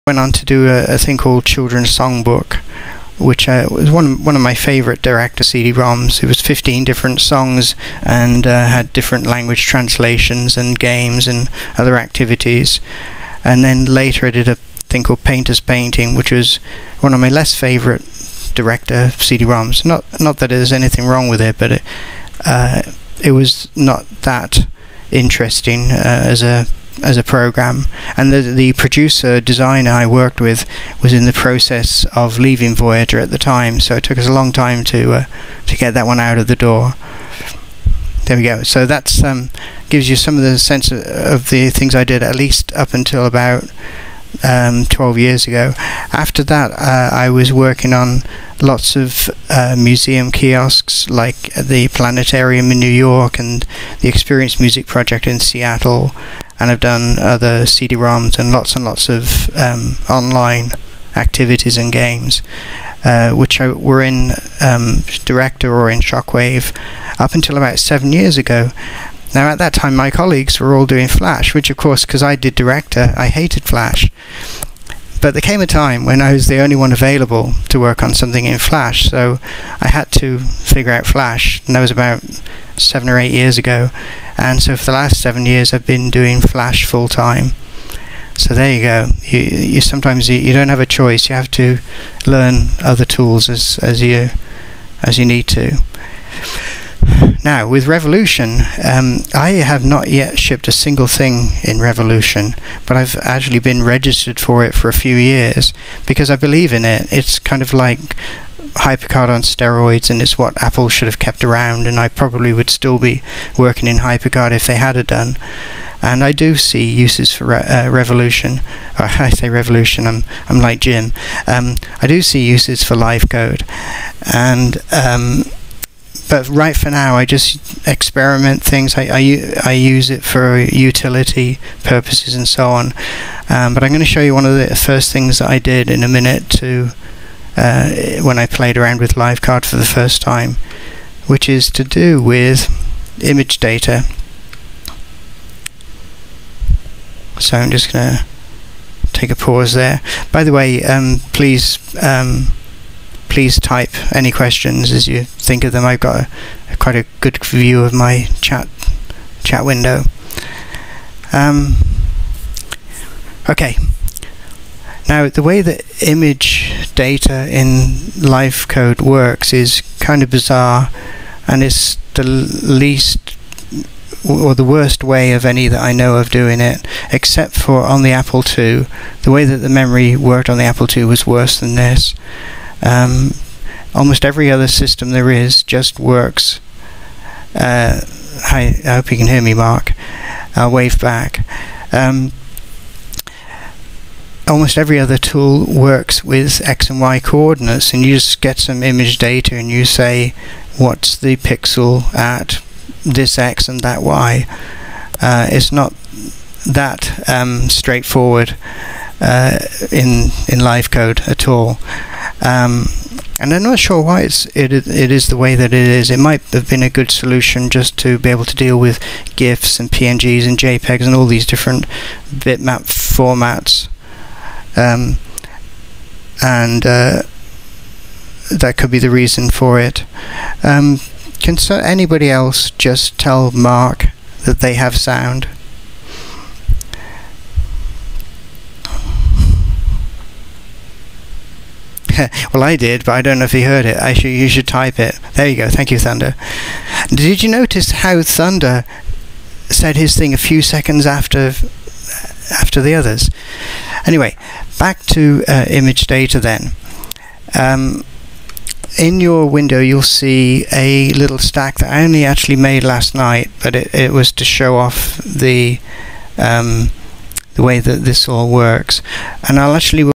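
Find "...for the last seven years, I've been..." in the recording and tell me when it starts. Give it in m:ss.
1:24.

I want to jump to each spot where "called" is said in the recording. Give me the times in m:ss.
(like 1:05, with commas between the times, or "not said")
0:01, 0:15.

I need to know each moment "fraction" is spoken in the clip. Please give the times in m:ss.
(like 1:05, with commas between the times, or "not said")
not said.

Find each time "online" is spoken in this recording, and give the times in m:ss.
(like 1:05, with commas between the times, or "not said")
1:00.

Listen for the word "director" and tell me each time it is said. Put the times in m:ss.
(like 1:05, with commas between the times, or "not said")
0:05, 0:18, 1:05, 1:12.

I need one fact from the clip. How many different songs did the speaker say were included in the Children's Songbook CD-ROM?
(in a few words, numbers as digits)
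15.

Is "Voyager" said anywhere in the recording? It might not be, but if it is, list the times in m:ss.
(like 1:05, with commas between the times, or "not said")
0:32.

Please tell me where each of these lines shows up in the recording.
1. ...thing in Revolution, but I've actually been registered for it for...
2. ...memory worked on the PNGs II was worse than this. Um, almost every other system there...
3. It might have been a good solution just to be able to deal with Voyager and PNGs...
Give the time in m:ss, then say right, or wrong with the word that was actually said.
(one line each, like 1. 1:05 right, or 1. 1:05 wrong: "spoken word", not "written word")
1. 1:41 right
2. 2:59 wrong: "Apple", not "PNGs"
3. 3:36 wrong: "GIFs", not "Voyager".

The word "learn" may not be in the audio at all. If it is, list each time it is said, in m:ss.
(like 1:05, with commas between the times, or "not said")
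1:32.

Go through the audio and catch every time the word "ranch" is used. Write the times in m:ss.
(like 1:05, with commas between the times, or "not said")
not said.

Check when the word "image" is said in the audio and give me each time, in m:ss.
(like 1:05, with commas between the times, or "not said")
2:23, 2:46, 3:18, 4:15.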